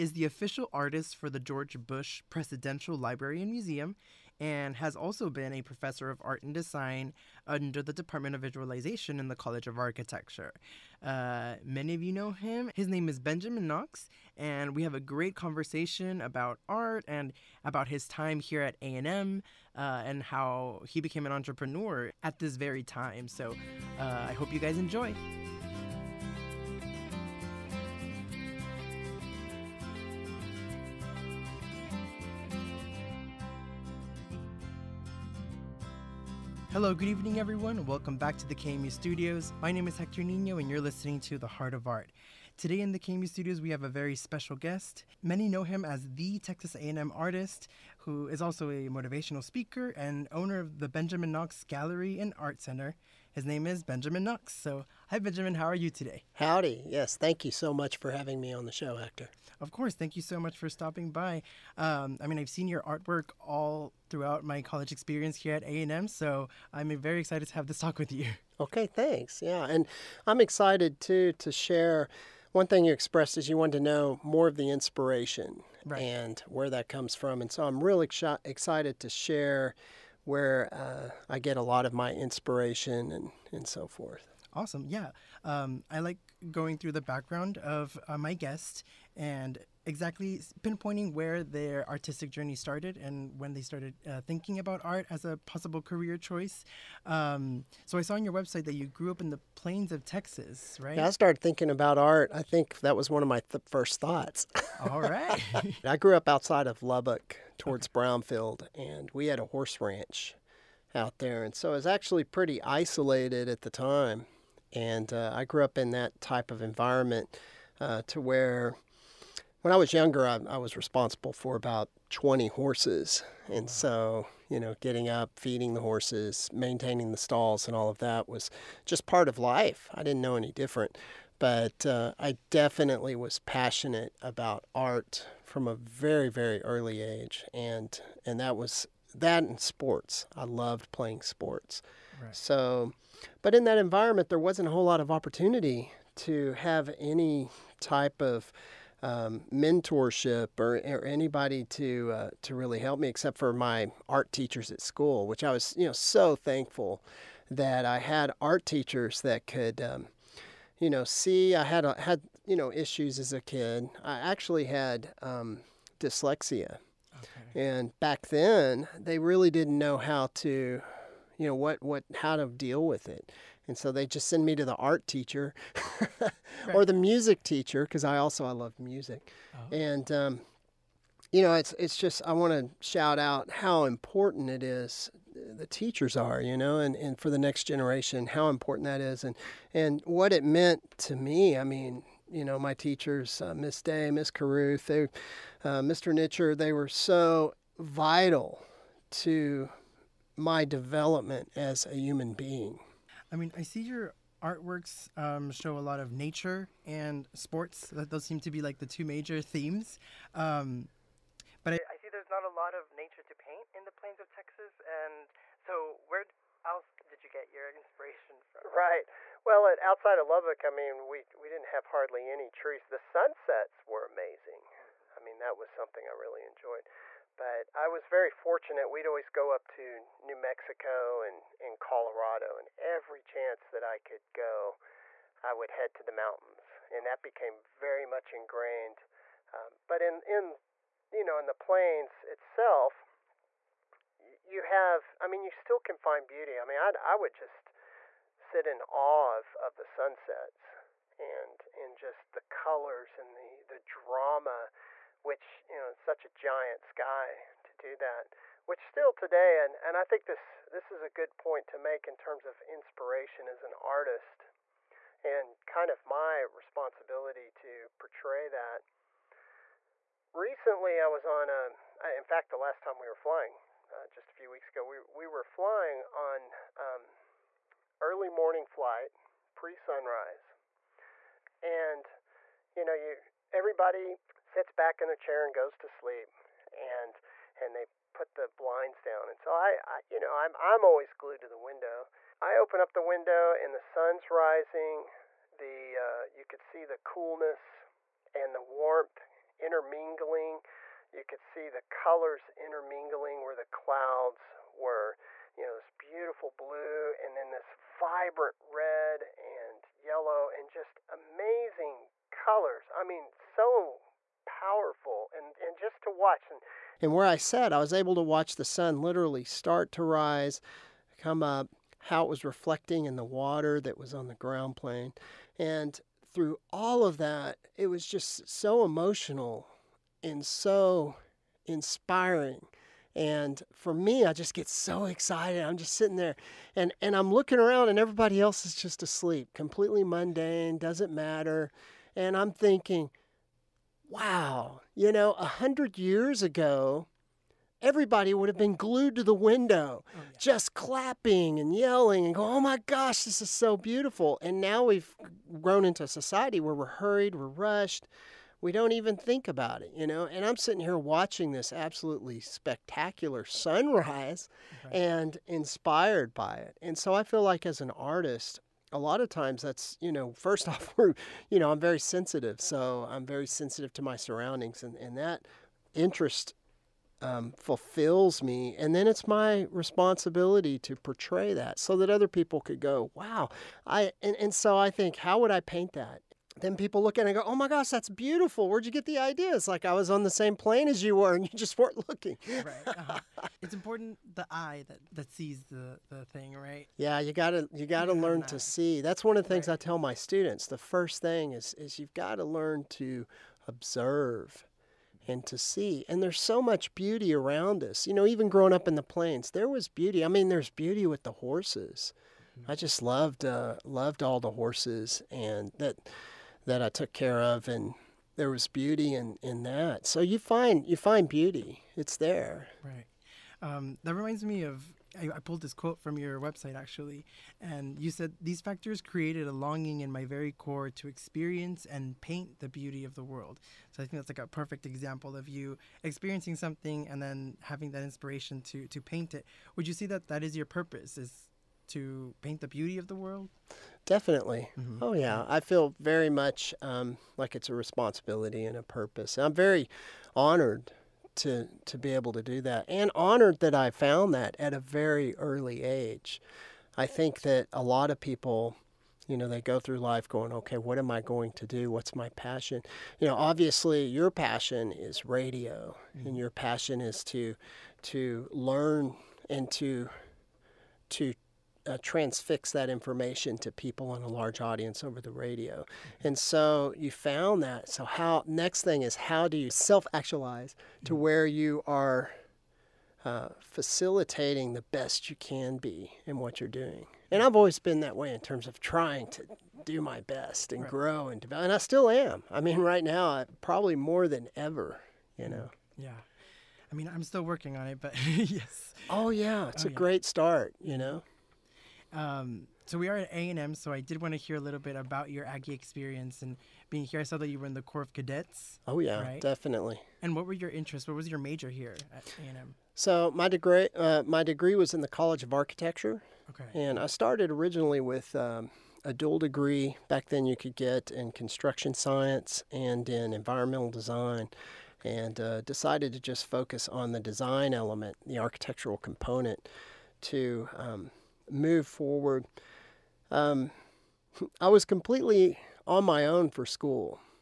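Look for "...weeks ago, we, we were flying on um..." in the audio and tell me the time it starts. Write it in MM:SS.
04:34.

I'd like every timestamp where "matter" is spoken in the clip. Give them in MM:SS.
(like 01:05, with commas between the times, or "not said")
05:41.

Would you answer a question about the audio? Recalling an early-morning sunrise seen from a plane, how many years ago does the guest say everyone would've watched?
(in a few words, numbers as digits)
100.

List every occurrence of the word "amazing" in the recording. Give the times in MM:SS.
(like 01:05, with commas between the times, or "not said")
03:44, 05:11.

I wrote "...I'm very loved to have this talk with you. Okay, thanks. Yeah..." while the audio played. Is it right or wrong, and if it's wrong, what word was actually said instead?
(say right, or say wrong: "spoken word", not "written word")
wrong: "excited", not "loved".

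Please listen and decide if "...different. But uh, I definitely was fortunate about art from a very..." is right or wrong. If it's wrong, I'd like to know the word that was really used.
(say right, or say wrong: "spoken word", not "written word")
wrong: "passionate", not "fortunate".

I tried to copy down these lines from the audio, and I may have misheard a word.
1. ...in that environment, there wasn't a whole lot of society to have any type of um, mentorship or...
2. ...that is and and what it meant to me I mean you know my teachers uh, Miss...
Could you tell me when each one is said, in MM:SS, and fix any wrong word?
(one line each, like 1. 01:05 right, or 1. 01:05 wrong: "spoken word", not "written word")
1. 02:23 wrong: "opportunity", not "society"
2. 03:08 right.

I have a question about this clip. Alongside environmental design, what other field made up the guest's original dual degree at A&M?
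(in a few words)
Construction science.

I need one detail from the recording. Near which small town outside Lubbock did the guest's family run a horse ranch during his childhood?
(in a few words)
Brownfield.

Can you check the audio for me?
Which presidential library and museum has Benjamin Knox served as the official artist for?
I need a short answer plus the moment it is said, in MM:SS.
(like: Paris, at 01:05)
George Bush Presidential Library and Museum, at 00:01.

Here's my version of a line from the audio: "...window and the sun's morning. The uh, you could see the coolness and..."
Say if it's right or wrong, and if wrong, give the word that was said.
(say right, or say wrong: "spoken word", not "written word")
wrong: "rising", not "morning".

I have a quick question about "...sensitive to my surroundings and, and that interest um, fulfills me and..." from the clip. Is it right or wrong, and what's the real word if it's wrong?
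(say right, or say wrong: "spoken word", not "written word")
right.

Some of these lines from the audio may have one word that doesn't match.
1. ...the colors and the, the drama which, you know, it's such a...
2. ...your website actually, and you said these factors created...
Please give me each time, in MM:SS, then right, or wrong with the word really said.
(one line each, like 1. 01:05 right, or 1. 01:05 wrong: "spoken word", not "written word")
1. 04:12 right
2. 07:06 right.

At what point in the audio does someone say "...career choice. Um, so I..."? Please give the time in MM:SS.
01:35.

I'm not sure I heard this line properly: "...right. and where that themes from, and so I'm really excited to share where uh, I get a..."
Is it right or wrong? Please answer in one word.
wrong.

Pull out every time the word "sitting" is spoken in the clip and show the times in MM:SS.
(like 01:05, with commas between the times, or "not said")
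05:35, 06:00.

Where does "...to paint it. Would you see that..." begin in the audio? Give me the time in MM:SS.
07:18.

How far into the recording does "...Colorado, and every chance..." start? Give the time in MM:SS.
03:51.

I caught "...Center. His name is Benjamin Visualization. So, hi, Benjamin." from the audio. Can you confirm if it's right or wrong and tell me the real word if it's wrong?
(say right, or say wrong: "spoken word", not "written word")
wrong: "Knox", not "Visualization".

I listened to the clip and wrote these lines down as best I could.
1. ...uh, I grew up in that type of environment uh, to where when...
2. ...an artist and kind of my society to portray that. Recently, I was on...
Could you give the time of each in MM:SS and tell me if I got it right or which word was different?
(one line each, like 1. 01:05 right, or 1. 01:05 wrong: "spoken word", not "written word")
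1. 01:55 right
2. 04:23 wrong: "responsibility", not "society".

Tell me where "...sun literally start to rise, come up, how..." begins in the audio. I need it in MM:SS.
05:18.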